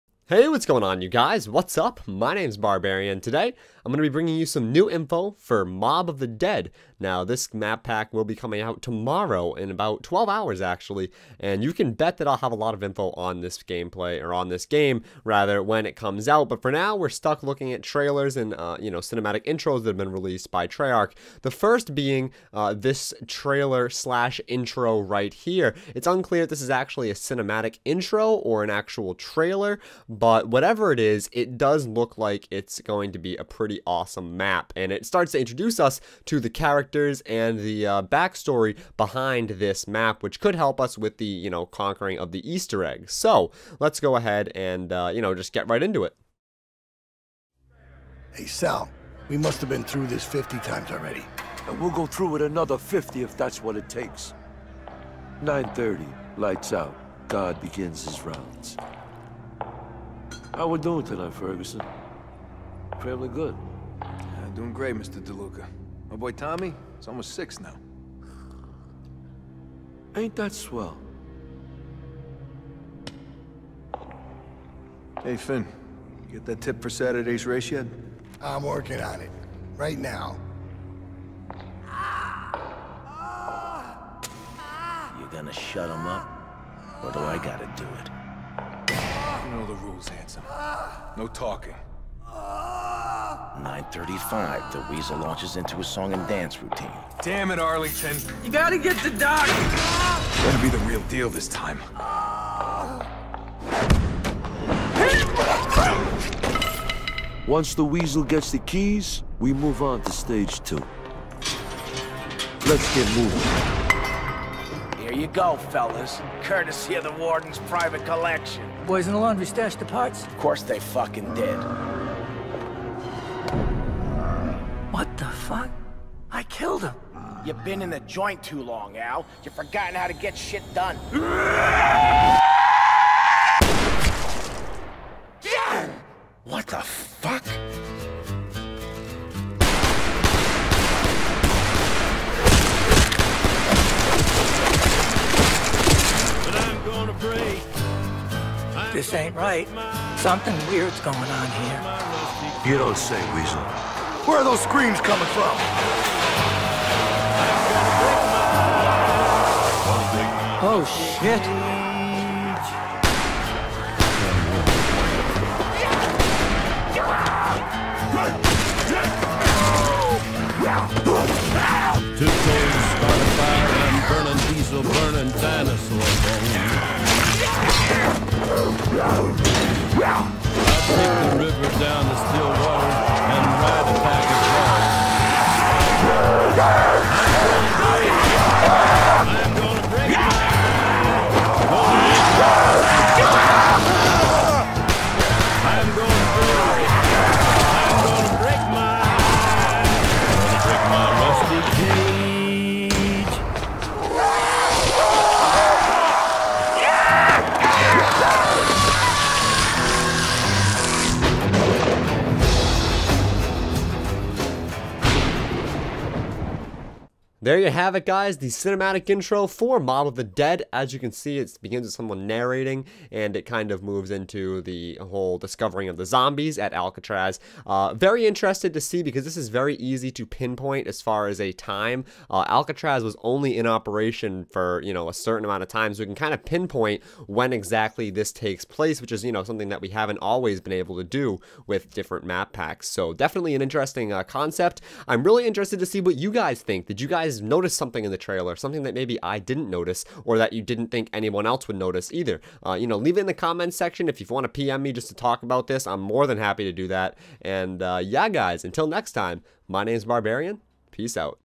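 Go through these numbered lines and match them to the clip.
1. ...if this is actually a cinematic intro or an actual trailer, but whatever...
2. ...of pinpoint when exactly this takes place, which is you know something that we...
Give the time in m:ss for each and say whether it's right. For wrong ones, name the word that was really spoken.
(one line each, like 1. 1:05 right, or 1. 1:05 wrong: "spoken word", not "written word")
1. 0:26 right
2. 3:56 right.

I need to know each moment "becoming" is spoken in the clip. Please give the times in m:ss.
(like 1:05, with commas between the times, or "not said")
not said.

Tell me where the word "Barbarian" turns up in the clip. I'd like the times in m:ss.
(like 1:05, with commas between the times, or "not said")
0:02, 4:20.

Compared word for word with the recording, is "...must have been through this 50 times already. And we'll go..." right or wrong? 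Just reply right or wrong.
right.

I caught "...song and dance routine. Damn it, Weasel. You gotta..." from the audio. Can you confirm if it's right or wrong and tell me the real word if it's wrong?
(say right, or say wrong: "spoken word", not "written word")
wrong: "Arlington", not "Weasel".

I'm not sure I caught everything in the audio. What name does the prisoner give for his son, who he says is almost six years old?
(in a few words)
Tommy.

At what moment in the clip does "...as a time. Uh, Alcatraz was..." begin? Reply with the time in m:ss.
3:51.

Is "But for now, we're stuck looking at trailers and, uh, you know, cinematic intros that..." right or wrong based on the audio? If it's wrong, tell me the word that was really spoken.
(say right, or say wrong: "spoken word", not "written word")
right.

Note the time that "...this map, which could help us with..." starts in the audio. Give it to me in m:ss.
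0:39.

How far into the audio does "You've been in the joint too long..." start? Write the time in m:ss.
2:07.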